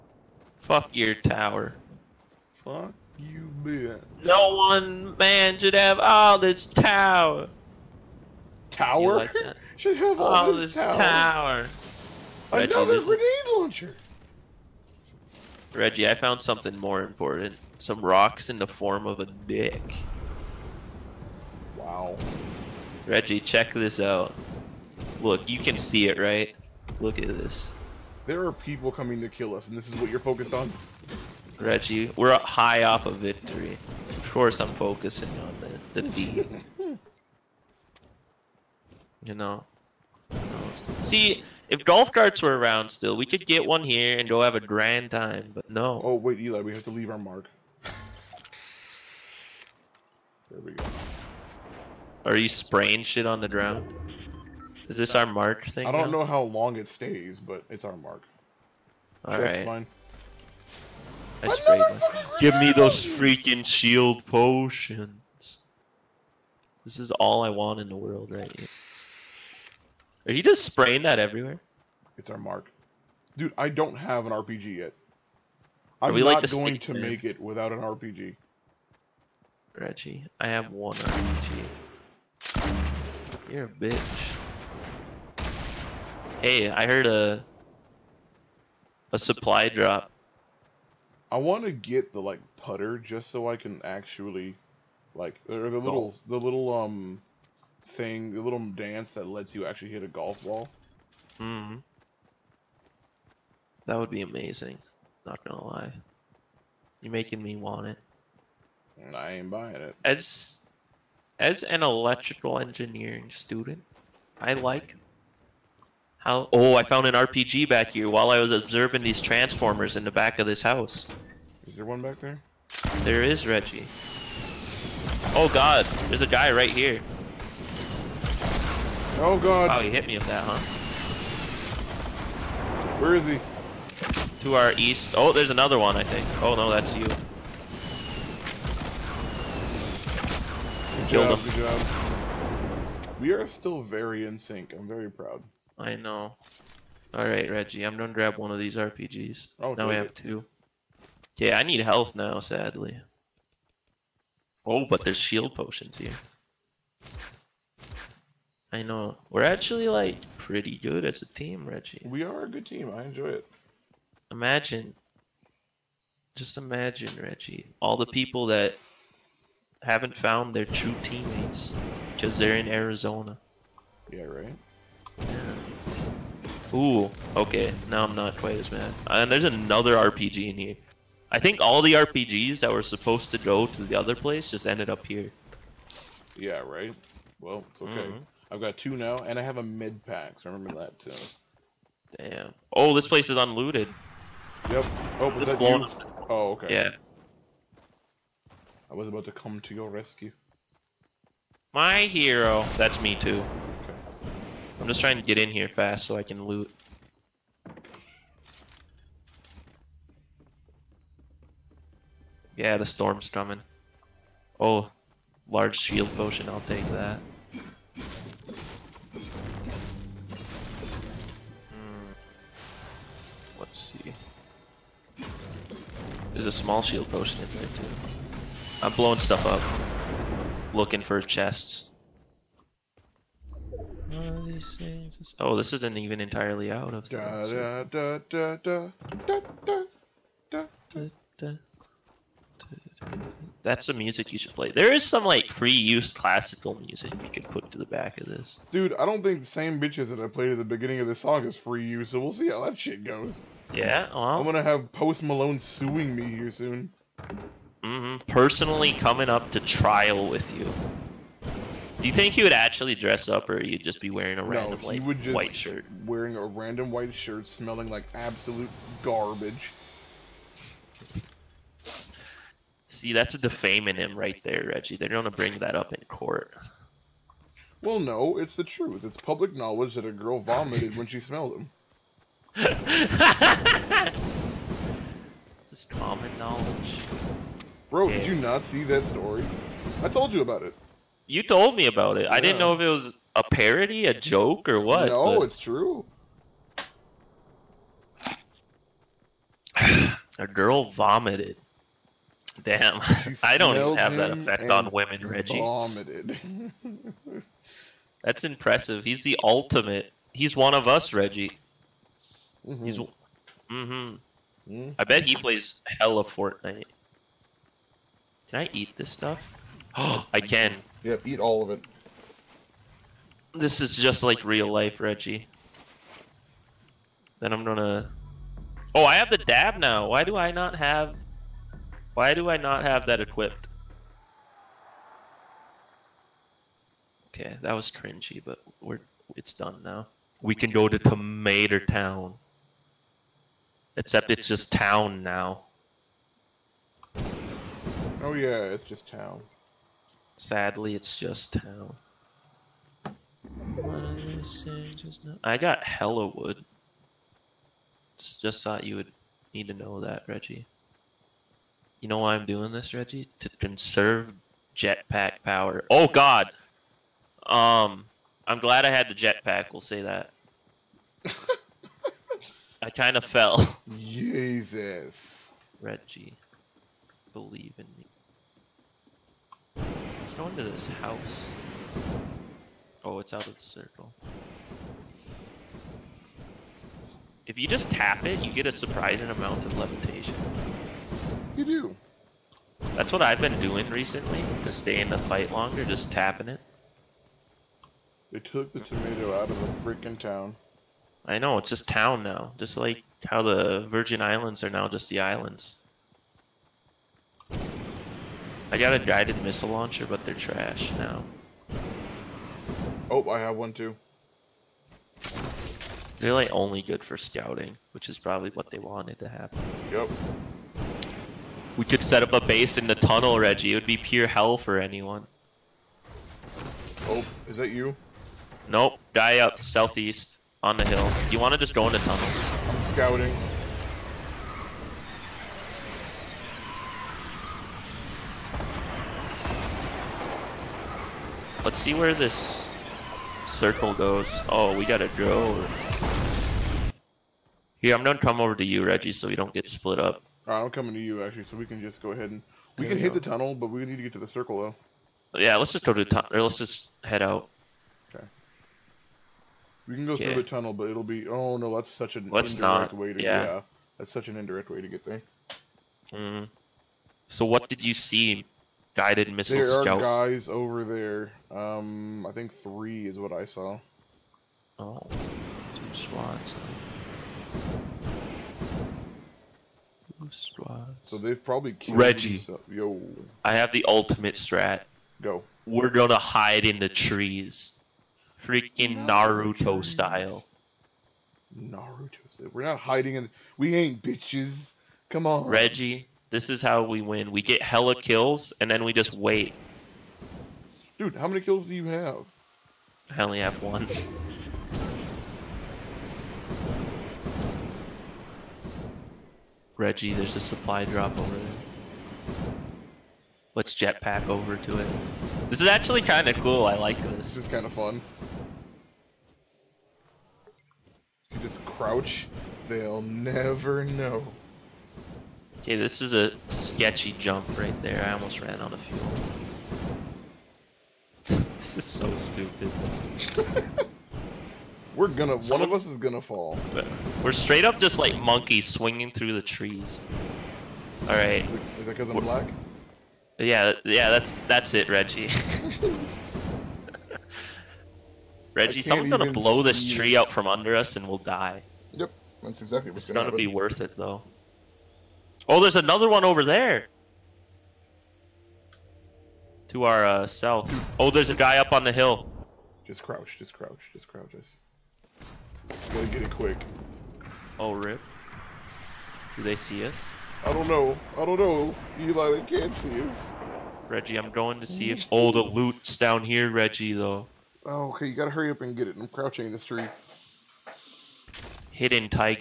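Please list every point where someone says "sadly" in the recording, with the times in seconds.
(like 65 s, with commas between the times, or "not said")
152 s, 350 s.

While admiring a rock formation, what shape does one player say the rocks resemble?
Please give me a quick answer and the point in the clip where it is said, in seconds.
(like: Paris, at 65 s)
A dick, at 17 s.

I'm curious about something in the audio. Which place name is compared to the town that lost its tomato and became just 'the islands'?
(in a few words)
Virgin Islands.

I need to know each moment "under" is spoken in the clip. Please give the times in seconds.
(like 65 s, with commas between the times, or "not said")
550 s.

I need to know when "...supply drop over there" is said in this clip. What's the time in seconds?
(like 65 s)
510 s.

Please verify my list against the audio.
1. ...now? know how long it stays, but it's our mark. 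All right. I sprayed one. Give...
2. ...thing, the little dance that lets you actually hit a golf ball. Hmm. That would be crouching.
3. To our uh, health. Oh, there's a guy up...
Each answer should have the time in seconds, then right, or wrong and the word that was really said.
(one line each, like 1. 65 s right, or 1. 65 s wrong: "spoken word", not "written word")
1. 56 s right
2. 97 s wrong: "amazing", not "crouching"
3. 559 s wrong: "south", not "health".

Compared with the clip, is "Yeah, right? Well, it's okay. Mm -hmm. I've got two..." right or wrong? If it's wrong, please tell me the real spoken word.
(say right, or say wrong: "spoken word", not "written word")
right.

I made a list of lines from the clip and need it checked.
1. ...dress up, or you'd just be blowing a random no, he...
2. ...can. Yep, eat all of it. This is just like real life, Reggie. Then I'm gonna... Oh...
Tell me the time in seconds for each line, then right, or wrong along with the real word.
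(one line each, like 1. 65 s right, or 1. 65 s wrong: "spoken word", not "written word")
1. 262 s wrong: "wearing", not "blowing"
2. 320 s right.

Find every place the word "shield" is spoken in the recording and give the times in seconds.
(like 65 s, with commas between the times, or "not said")
63 s, 155 s, 215 s, 226 s.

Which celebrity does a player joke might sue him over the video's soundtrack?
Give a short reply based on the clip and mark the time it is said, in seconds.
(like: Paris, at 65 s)
Post Malone, at 254 s.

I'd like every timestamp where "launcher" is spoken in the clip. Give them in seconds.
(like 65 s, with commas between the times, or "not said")
13 s, 409 s.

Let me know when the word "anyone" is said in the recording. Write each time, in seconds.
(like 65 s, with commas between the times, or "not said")
424 s.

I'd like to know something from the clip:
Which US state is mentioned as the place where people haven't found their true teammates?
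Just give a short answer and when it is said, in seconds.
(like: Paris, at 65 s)
Arizona, at 172 s.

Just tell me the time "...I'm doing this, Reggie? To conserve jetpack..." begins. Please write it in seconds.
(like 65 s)
362 s.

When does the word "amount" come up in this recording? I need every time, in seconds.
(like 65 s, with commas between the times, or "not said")
389 s.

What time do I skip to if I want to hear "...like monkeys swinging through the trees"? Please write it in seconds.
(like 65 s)
537 s.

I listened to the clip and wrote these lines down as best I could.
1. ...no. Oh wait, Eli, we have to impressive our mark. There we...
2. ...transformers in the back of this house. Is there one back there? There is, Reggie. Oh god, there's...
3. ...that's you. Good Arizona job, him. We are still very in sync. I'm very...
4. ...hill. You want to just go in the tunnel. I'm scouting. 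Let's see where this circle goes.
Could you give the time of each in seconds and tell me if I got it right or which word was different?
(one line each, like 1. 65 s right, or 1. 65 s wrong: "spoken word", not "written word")
1. 45 s wrong: "leave", not "impressive"
2. 119 s right
3. 136 s wrong: "Killed", not "Arizona"
4. 430 s right.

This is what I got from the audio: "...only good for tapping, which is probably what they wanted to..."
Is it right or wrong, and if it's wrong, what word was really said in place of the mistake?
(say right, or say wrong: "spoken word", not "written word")
wrong: "scouting", not "tapping".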